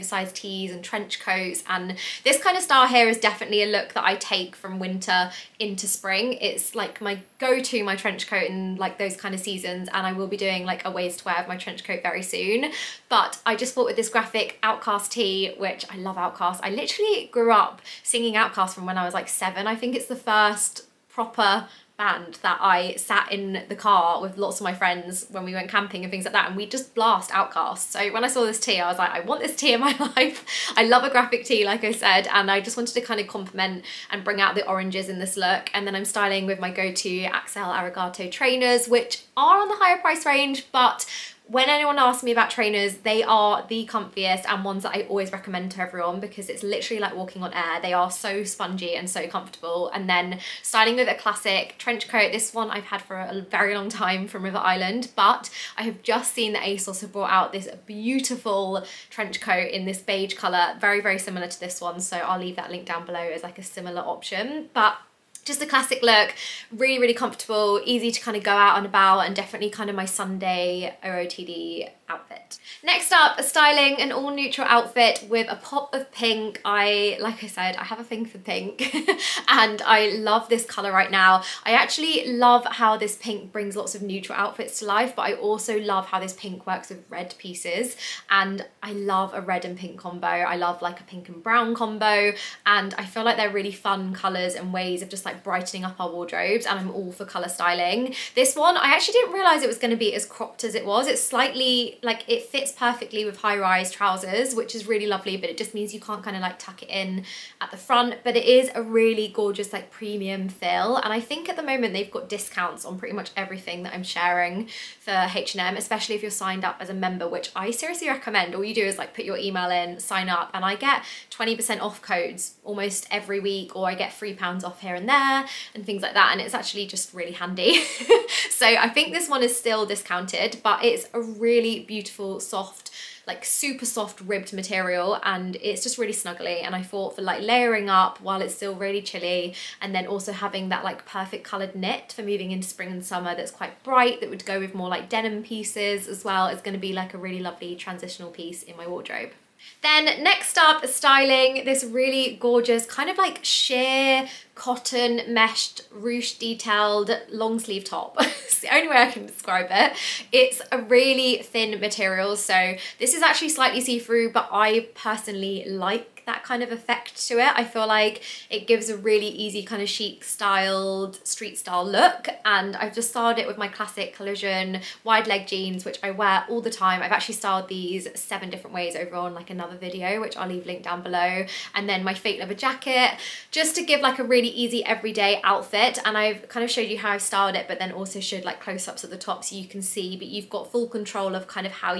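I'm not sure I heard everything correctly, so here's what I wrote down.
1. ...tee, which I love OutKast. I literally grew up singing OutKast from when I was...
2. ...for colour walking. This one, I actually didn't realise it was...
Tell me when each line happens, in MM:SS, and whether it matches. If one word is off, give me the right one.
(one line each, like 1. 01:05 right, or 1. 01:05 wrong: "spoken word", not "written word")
1. 00:15 right
2. 01:37 wrong: "styling", not "walking".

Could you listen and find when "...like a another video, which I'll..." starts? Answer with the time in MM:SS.
02:59.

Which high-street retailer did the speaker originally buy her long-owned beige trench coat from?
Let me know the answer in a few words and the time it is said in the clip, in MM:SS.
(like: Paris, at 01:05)
River Island, at 00:54.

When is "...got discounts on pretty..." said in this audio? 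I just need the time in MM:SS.
01:52.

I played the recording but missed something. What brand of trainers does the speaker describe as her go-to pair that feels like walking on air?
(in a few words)
Axel Arigato.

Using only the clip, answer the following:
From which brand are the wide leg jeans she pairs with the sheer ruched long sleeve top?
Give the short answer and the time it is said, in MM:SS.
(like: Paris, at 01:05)
Collusion, at 02:54.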